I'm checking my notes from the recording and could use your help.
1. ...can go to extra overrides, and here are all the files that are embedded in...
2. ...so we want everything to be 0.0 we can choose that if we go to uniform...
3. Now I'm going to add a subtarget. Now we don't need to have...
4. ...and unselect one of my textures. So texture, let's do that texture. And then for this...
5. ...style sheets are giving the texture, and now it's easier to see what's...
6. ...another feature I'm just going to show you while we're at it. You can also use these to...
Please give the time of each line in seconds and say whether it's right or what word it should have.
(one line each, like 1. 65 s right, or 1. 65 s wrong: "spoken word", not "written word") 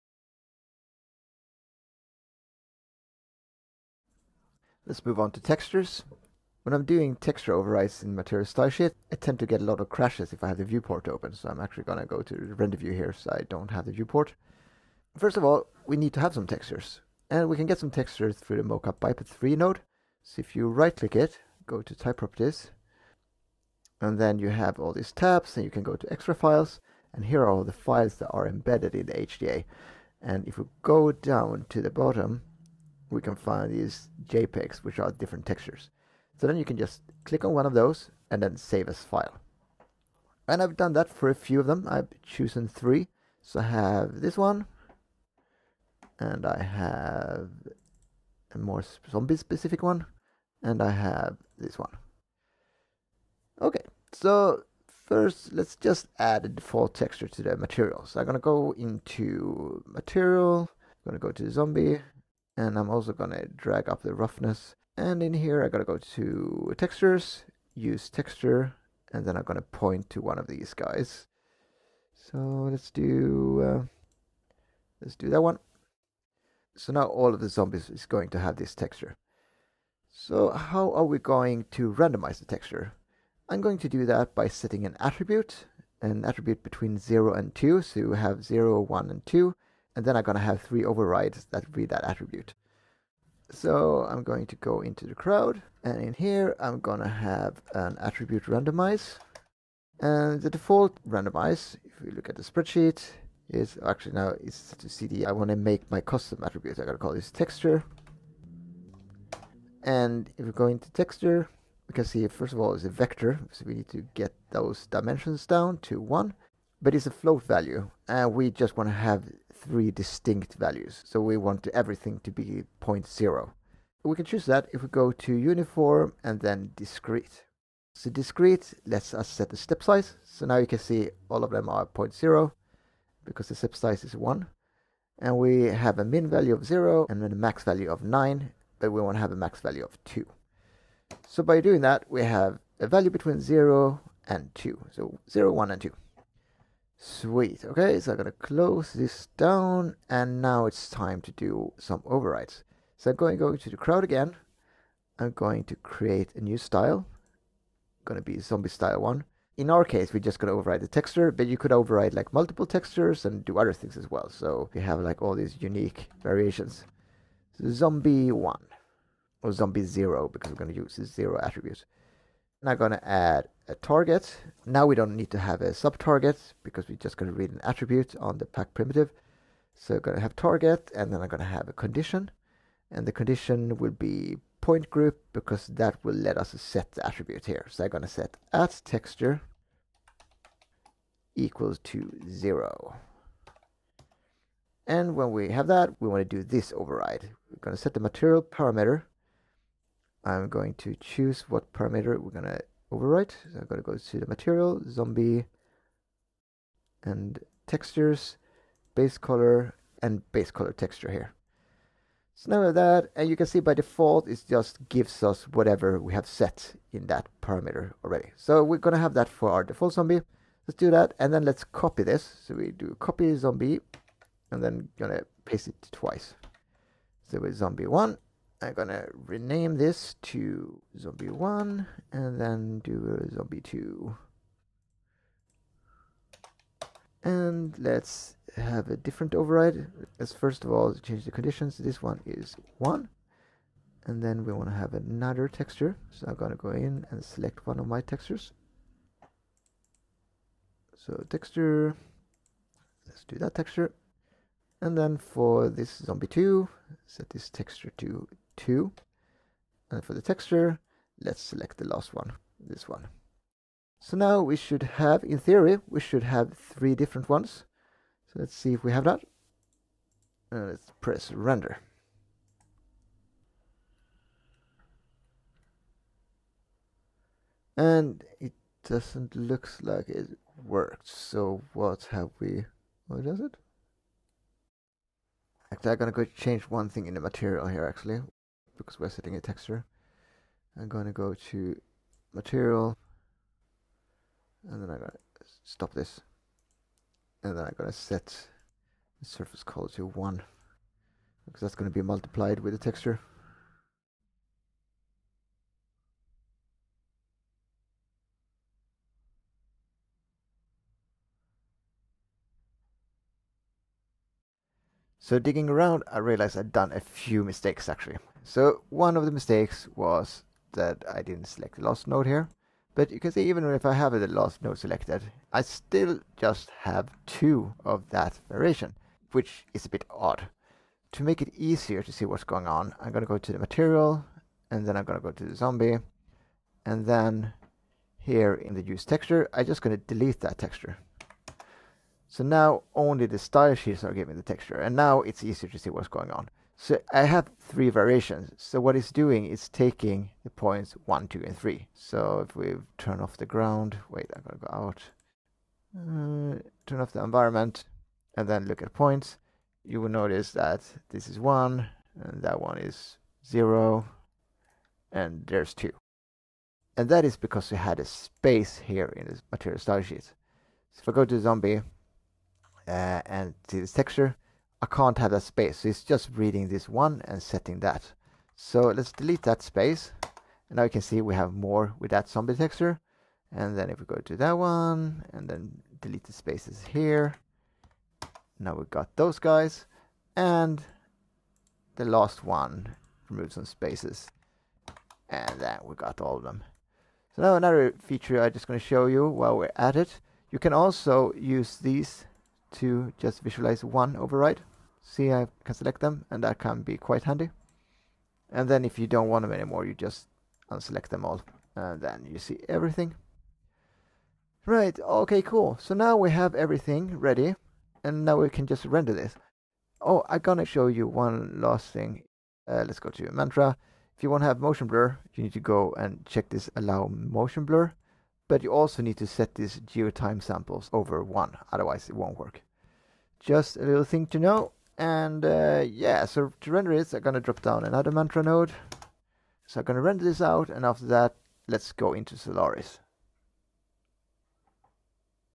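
1. 25 s wrong: "files", not "overrides"
2. 121 s right
3. 172 s wrong: "target", not "subtarget"
4. 247 s wrong: "select", not "unselect"
5. 343 s right
6. 397 s right.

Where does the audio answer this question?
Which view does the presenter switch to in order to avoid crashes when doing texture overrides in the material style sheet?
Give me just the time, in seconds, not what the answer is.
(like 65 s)
12 s.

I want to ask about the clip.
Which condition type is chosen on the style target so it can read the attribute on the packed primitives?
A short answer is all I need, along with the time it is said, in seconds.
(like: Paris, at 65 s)
point group, at 184 s.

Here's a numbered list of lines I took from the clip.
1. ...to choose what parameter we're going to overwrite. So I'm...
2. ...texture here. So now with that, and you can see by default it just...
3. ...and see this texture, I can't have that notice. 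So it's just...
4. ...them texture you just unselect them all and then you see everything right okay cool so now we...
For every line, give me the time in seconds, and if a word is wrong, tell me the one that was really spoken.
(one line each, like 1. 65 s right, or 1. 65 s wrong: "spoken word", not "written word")
1. 200 s right
2. 210 s right
3. 373 s wrong: "space", not "notice"
4. 409 s wrong: "anymore", not "texture".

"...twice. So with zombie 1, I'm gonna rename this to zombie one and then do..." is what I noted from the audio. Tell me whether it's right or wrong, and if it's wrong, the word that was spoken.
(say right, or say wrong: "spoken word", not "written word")
right.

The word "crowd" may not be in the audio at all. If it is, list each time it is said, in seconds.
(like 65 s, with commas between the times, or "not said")
95 s, 153 s.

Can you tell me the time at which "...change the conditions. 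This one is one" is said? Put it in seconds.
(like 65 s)
240 s.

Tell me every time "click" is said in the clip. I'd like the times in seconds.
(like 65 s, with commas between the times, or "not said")
20 s, 37 s.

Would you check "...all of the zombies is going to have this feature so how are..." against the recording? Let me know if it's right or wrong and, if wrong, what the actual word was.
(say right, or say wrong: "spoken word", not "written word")
wrong: "texture", not "feature".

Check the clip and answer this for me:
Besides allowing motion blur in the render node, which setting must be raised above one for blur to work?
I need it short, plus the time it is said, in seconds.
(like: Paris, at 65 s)
geotime samples, at 429 s.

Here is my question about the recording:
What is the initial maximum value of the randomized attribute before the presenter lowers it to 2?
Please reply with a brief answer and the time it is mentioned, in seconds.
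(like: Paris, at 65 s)
9, at 138 s.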